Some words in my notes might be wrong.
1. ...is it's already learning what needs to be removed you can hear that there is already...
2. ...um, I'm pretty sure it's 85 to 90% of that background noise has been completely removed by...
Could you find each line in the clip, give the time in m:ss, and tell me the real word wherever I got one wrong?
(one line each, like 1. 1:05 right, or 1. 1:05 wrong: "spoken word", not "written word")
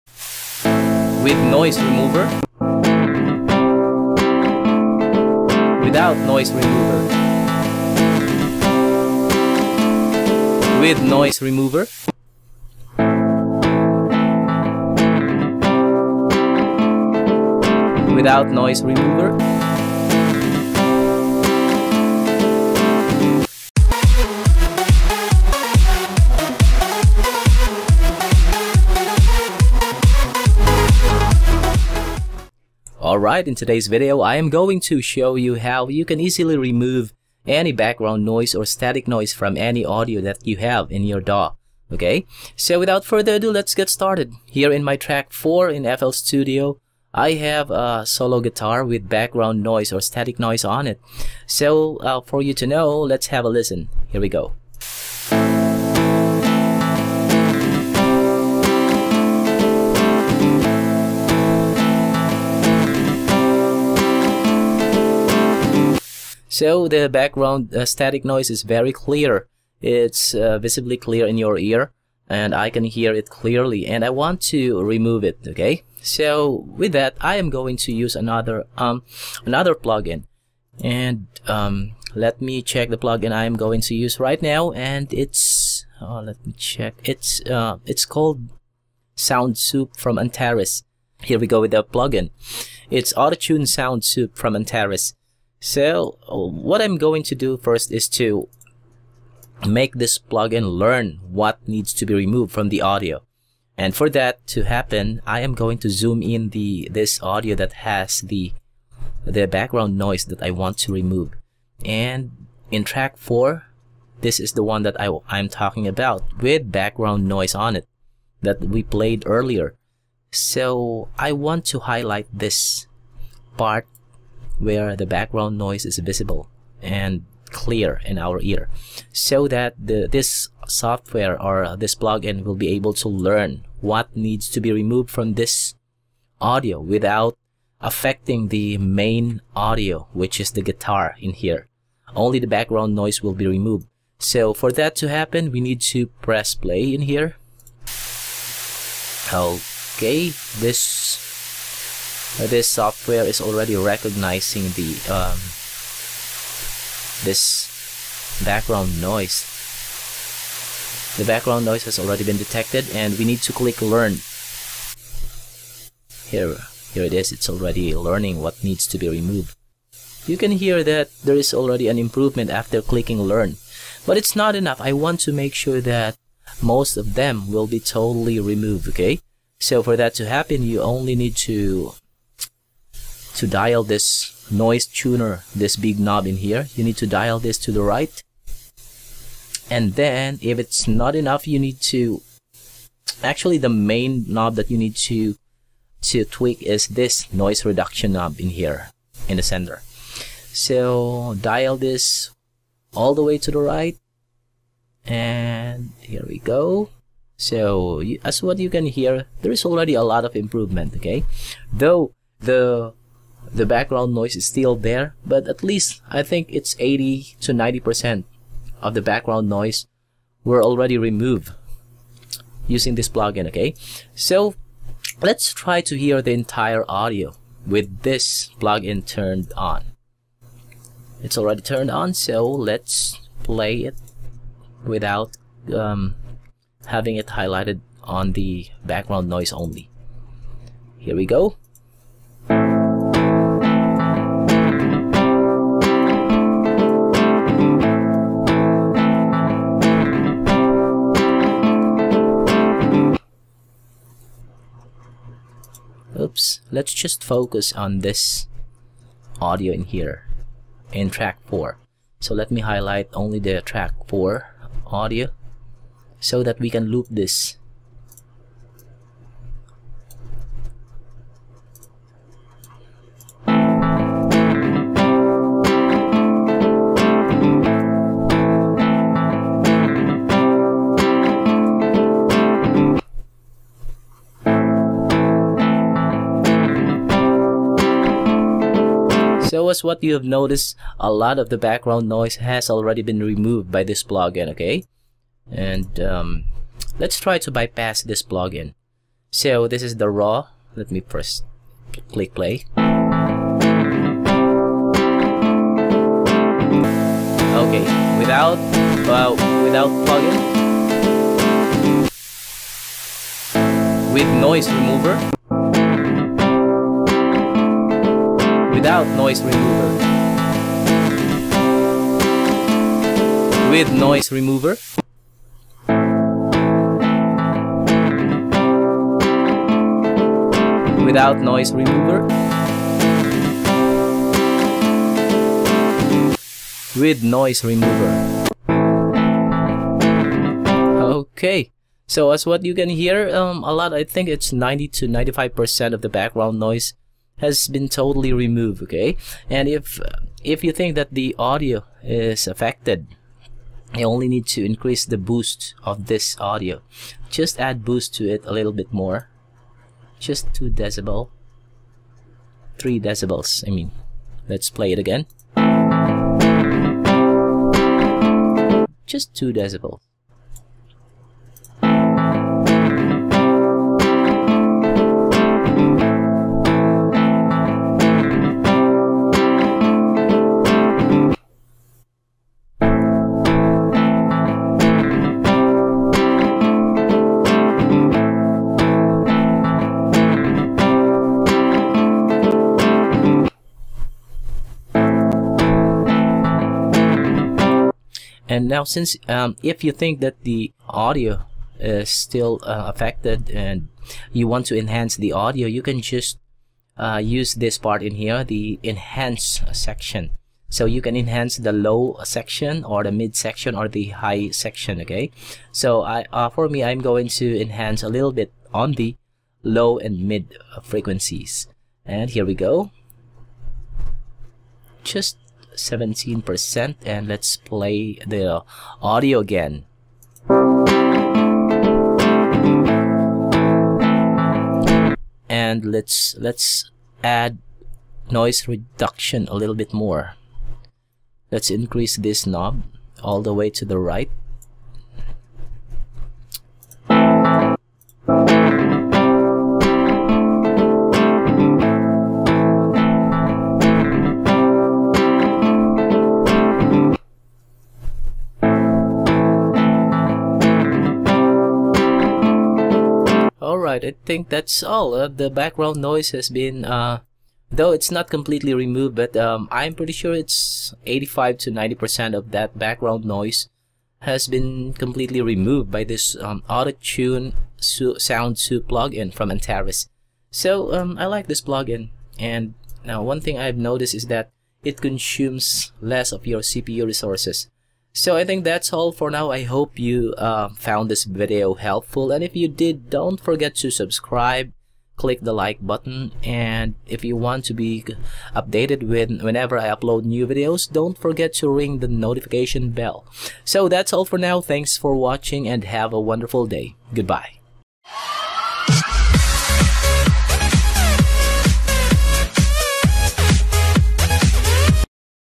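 1. 2:47 right
2. 7:49 right.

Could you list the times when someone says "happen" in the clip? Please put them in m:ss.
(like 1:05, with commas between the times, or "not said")
1:44, 2:25, 3:00.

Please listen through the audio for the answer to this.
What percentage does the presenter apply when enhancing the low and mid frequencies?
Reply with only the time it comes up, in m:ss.
7:05.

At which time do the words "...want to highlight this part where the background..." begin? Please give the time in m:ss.
2:01.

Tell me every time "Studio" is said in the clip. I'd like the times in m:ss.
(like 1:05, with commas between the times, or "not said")
0:46.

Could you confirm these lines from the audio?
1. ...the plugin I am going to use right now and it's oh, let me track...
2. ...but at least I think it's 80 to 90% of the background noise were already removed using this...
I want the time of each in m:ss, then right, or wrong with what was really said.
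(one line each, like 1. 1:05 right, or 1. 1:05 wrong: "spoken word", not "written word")
1. 1:22 wrong: "check", not "track"
2. 3:35 right.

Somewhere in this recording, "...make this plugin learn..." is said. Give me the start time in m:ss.
1:39.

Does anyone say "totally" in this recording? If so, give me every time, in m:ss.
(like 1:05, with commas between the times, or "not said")
2:57, 5:47.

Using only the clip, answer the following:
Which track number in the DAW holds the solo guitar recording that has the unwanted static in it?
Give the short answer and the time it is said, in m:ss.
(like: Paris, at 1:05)
4, at 0:44.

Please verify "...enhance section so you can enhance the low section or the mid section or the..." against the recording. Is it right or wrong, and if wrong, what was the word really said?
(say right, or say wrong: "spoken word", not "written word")
right.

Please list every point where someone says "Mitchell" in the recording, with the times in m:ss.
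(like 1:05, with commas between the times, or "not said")
not said.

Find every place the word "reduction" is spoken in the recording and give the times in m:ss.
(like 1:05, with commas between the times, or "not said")
3:17, 7:18.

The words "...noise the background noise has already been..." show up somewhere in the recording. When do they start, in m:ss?
2:39.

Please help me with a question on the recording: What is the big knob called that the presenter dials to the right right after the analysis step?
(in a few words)
noise tuner.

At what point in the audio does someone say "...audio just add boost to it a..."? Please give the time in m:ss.
5:56.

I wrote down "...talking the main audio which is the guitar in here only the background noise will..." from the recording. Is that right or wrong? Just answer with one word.
wrong.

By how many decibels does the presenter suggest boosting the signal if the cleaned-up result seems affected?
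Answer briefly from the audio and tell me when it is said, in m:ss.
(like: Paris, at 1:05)
2 decibels, at 6:09.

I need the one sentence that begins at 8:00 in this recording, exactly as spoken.
So um, I like this plugin, and now one thing I've noticed is that it consumes less of your CPU resources.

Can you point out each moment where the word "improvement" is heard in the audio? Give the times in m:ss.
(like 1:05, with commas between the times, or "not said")
2:51, 3:30.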